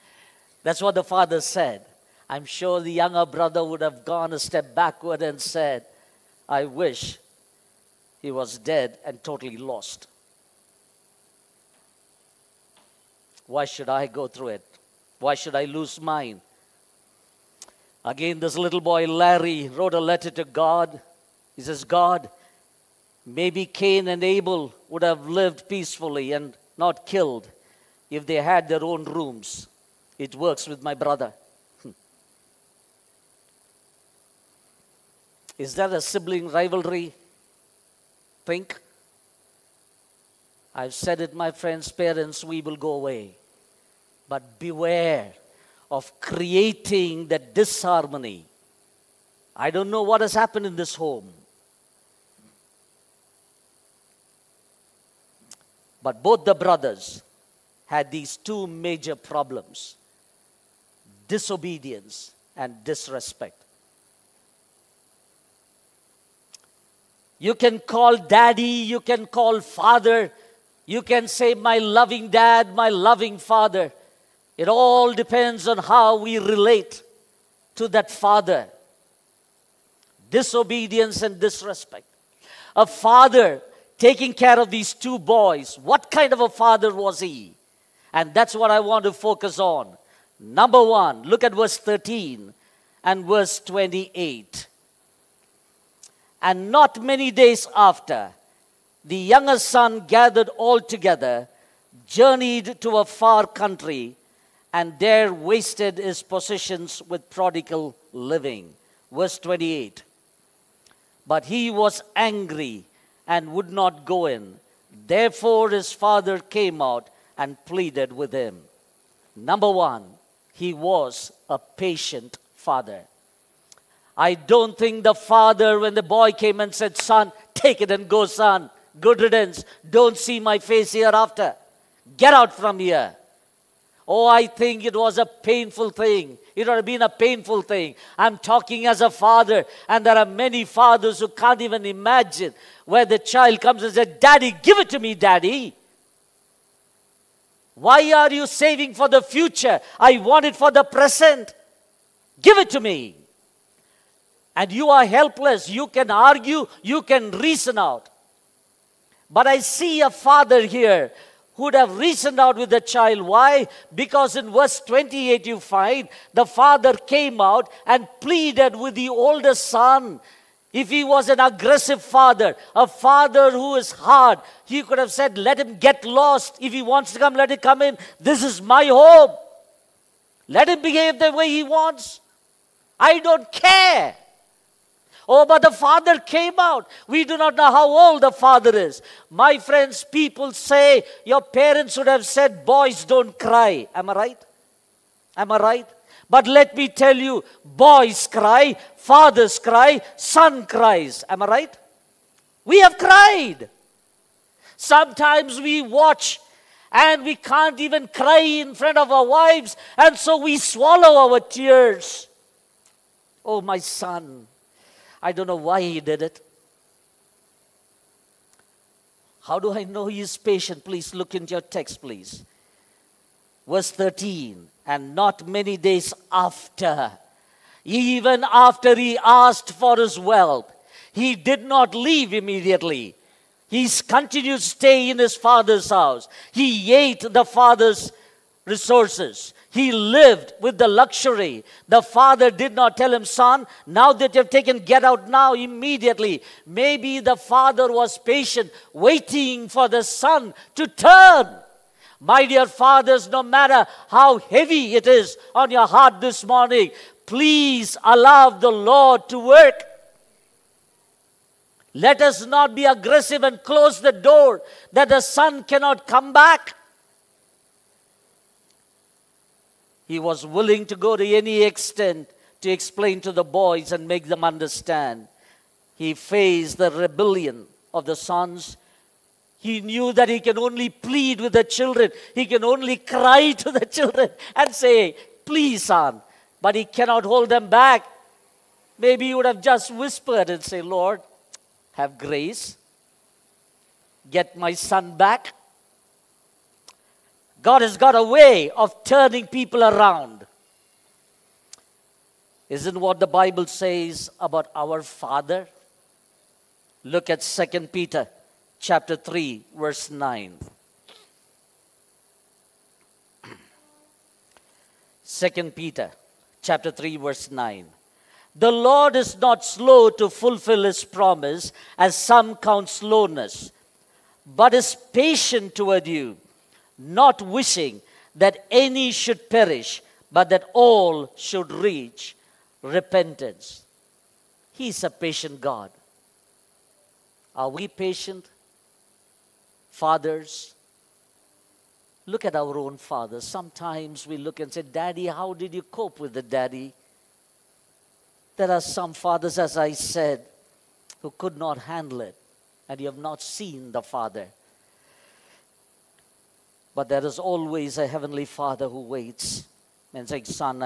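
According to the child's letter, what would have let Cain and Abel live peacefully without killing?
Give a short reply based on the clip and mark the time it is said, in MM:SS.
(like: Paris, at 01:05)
their own rooms, at 00:28.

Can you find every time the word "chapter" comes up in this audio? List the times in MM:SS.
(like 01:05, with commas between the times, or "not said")
05:08, 05:16.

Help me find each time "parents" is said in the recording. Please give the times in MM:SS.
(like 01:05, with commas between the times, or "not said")
00:41, 03:11.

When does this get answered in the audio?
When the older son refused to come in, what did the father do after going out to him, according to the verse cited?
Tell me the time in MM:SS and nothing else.
01:57.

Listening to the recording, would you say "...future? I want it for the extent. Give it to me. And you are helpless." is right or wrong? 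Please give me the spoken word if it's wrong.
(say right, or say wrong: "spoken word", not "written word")
wrong: "present", not "extent".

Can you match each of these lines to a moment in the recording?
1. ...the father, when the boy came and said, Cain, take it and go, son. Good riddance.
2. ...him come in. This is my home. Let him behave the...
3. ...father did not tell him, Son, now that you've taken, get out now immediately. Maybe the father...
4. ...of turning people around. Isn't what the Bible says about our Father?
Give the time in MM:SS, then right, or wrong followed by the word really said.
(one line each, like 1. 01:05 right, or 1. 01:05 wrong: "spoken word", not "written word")
1. 02:05 wrong: "Son", not "Cain"
2. 02:57 right
3. 04:02 right
4. 04:58 right.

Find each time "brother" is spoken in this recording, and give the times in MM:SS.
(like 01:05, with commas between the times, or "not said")
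00:03, 00:30, 00:56.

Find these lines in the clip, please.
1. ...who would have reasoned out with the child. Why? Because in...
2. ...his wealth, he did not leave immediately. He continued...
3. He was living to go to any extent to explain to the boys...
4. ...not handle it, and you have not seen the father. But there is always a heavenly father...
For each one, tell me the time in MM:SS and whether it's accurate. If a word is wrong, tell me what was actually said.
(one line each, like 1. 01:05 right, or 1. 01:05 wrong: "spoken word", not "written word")
1. 02:41 right
2. 03:49 right
3. 04:30 wrong: "willing", not "living"
4. 05:51 right.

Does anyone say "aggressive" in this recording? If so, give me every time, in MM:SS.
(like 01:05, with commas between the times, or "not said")
02:51, 04:22.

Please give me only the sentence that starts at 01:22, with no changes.
A father taking care of these two boys.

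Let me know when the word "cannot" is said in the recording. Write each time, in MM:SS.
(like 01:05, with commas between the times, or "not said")
04:25, 04:46.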